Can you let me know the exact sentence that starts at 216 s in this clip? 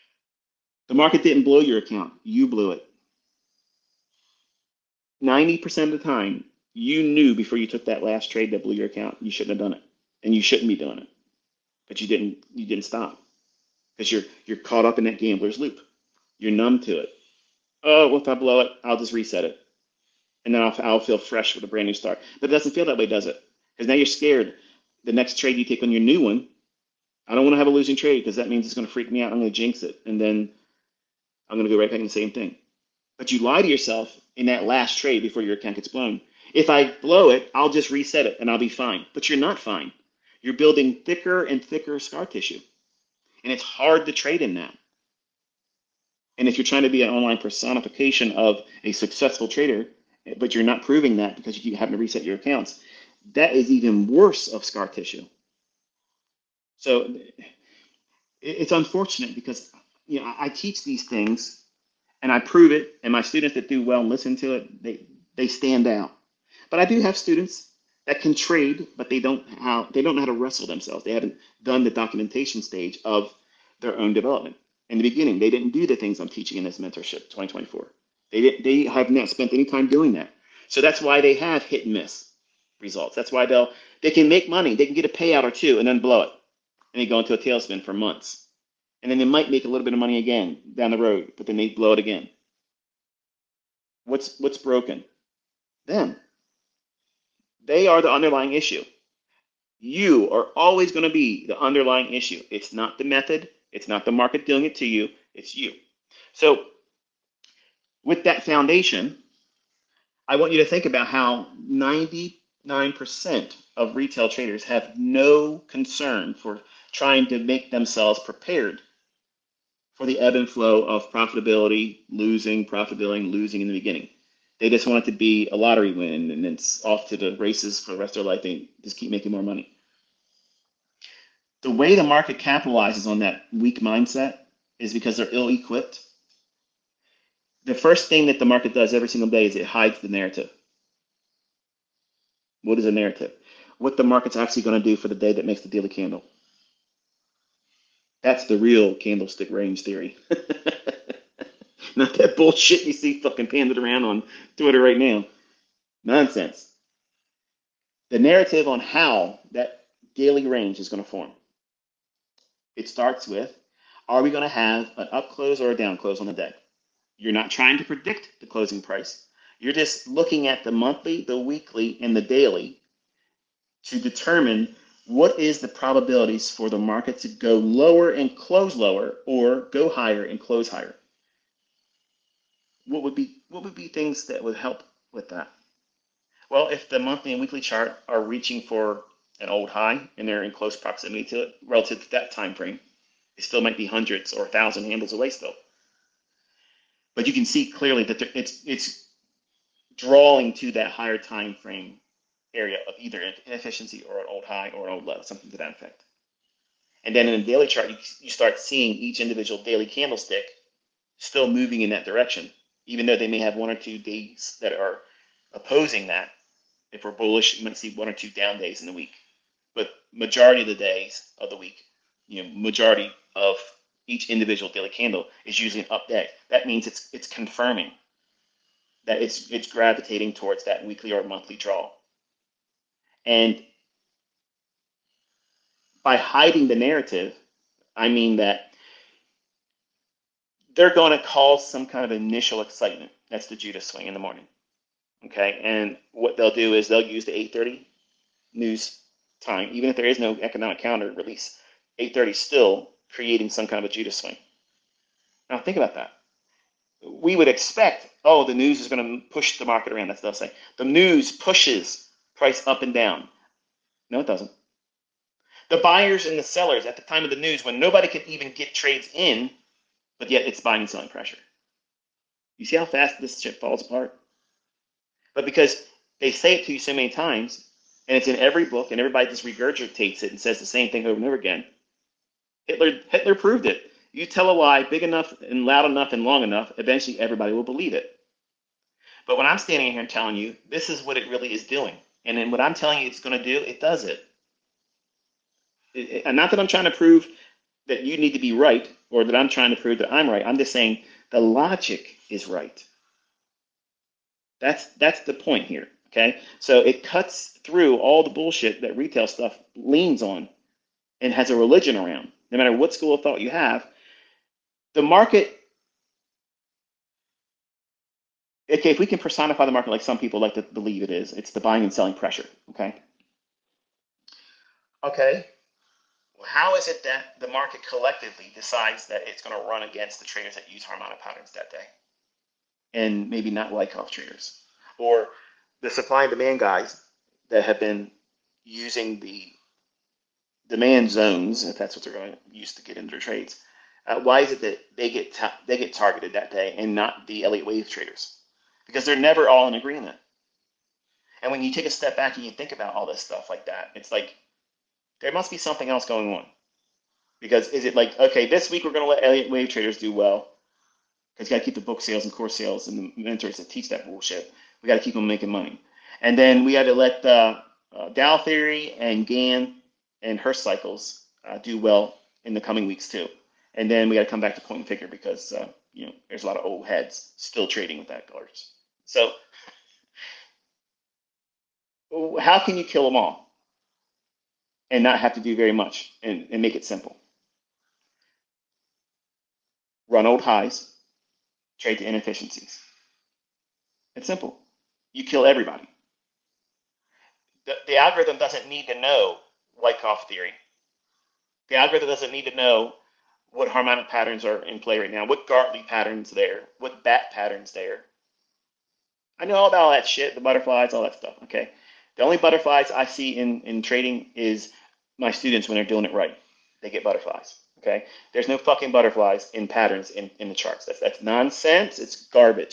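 If we're bullish, you might see one or two down days in the week.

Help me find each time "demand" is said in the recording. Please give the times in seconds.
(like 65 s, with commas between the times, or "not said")
336 s, 340 s.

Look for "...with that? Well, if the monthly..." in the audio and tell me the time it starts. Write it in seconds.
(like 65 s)
185 s.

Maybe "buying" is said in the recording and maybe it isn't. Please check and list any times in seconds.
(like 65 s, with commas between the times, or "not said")
270 s, 321 s.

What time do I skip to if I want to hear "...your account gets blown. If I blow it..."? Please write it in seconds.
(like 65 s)
35 s.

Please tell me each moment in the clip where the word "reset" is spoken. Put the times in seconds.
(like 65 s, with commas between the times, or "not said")
19 s, 37 s, 51 s.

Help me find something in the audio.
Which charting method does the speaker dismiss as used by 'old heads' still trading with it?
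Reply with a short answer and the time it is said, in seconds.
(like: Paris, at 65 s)
Point and figure, at 374 s.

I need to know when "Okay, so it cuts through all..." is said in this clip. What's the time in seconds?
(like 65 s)
306 s.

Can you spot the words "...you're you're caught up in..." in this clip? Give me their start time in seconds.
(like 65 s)
14 s.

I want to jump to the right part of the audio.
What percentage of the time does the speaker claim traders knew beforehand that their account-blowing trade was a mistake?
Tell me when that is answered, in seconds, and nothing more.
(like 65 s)
5 s.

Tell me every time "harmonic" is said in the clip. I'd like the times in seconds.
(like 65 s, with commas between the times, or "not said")
330 s, 403 s.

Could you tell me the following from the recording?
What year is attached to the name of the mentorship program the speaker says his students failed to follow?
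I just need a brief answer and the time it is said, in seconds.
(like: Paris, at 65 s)
2024, at 77 s.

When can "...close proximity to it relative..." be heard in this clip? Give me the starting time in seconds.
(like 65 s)
190 s.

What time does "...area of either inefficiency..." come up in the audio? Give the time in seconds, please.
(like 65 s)
202 s.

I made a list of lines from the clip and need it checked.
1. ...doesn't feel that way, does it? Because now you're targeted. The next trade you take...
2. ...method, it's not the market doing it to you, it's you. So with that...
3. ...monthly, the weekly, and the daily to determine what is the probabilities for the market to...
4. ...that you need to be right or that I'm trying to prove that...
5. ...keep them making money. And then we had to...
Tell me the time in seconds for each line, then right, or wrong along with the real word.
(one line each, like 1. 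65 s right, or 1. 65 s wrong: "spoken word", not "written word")
1. 22 s wrong: "scared", not "targeted"
2. 103 s right
3. 170 s right
4. 297 s right
5. 365 s right.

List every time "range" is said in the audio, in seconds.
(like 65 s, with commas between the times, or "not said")
149 s, 160 s.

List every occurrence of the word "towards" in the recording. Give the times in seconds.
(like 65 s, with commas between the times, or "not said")
230 s.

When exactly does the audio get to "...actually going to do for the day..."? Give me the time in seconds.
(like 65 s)
144 s.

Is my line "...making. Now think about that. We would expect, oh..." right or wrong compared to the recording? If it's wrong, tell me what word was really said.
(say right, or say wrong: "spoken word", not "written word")
wrong: "swing", not "making".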